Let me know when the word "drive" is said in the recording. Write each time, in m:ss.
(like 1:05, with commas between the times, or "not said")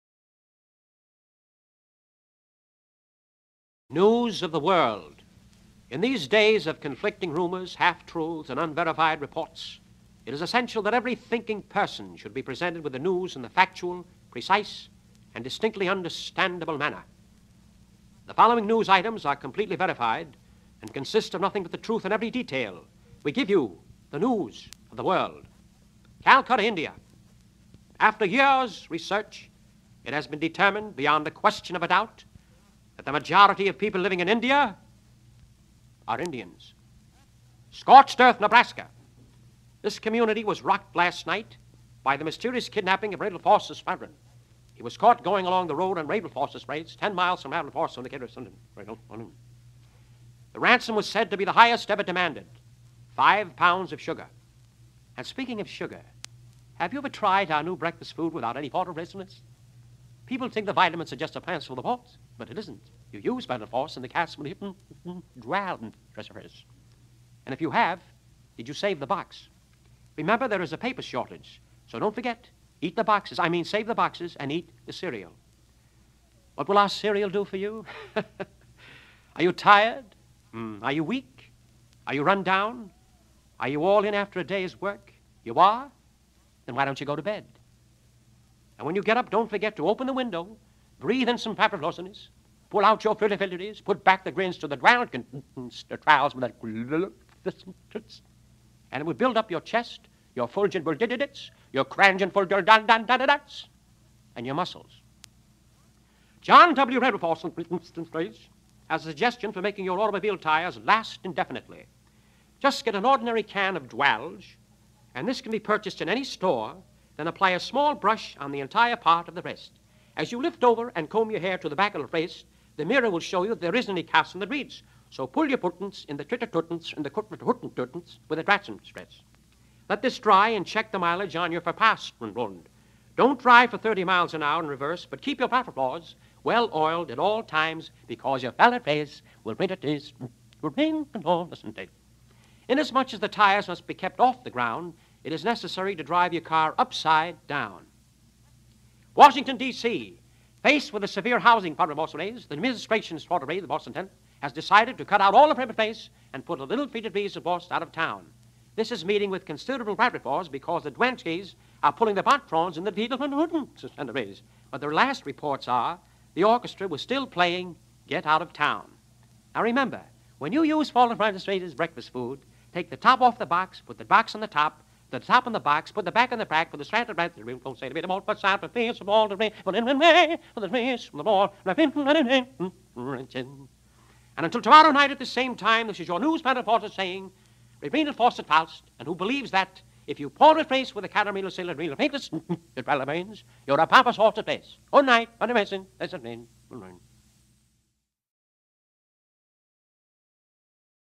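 2:13, 2:26.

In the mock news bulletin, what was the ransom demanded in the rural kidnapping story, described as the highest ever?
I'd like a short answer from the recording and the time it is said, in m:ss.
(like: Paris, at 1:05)
5 pounds of sugar, at 0:53.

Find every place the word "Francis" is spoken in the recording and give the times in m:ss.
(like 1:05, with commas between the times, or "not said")
2:51.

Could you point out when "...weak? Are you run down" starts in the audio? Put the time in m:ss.
1:21.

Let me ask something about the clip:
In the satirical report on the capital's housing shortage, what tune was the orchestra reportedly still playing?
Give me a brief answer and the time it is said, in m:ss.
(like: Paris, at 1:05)
Get Out of Town, at 2:48.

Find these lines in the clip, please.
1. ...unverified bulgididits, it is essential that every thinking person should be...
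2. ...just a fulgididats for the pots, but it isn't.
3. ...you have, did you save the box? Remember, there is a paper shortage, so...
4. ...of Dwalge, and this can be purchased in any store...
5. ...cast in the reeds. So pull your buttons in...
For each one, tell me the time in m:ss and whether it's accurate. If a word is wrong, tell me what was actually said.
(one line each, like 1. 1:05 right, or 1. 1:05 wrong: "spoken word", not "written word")
1. 0:08 wrong: "reports", not "bulgididits"
2. 1:01 wrong: "plants", not "fulgididats"
3. 1:07 right
4. 1:53 right
5. 2:04 right.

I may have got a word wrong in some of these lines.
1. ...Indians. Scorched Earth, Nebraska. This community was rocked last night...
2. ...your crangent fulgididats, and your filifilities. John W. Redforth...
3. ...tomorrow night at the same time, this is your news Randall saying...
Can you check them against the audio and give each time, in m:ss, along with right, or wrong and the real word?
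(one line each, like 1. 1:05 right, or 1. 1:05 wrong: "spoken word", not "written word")
1. 0:36 right
2. 1:41 wrong: "muscles", not "filifilities"
3. 3:04 wrong: "Foster", not "Randall".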